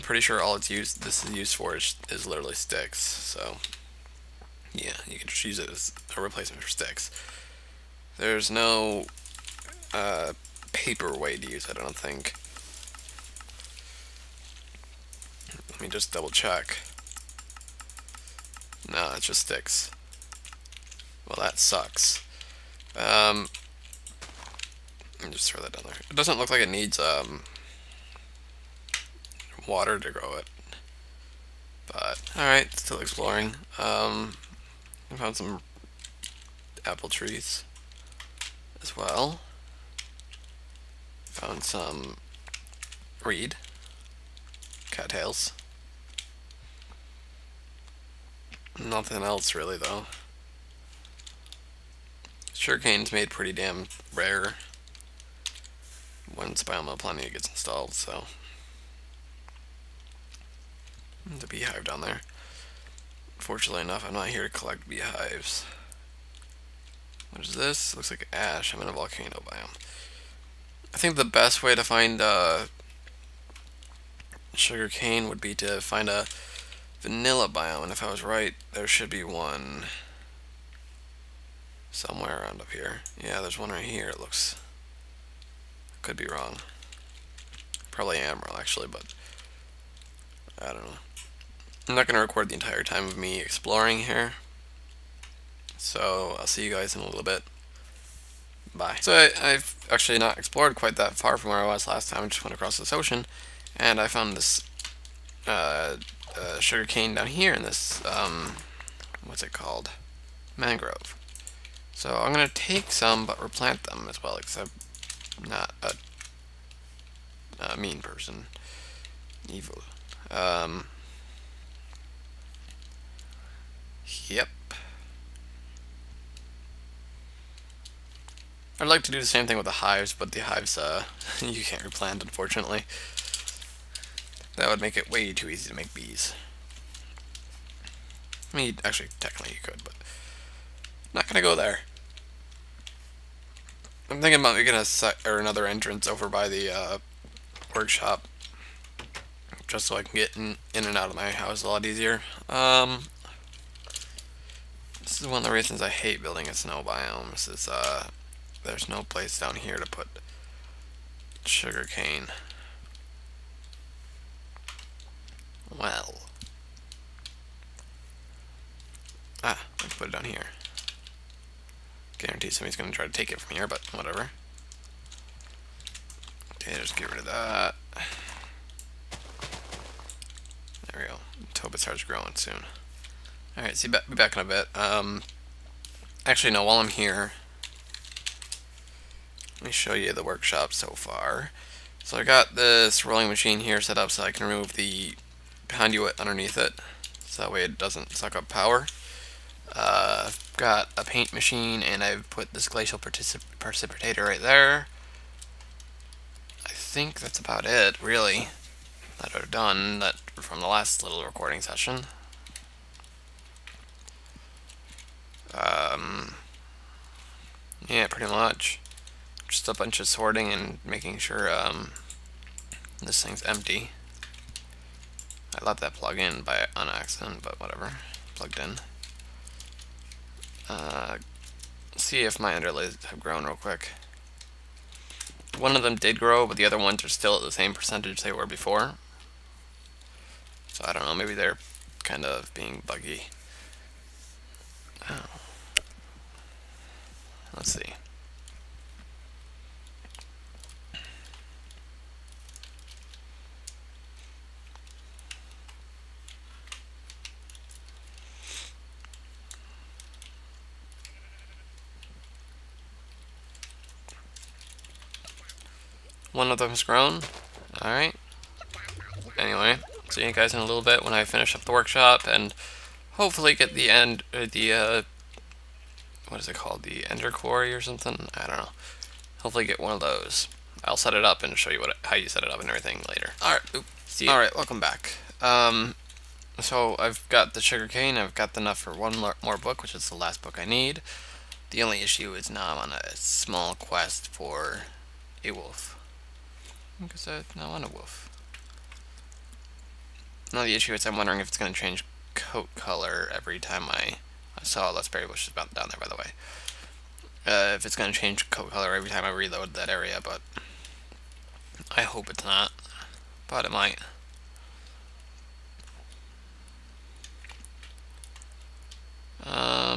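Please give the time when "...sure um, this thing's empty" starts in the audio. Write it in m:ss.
3:41.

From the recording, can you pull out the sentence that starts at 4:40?
I'll set it up and show you what how you set it up and everything later.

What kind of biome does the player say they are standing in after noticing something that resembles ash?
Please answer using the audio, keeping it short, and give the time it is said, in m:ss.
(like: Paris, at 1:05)
volcano biome, at 1:08.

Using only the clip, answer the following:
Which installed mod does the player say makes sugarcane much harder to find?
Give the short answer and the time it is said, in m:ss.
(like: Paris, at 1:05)
Biome Plenty, at 0:56.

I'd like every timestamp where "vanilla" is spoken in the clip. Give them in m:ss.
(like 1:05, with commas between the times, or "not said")
1:17.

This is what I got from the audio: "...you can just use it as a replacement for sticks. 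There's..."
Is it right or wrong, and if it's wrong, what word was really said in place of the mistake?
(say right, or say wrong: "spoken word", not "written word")
right.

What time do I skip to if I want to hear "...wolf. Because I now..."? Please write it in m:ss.
4:55.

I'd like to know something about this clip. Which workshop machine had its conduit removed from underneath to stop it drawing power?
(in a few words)
rolling machine.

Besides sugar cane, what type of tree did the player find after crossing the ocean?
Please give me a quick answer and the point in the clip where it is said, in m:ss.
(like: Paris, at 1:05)
Mangrove, at 1:50.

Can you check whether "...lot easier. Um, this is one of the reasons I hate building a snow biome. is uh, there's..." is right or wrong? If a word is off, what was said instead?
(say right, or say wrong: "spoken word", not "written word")
right.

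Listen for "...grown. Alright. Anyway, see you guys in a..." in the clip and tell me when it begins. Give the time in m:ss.
4:26.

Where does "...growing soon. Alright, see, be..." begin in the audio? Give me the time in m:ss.
3:02.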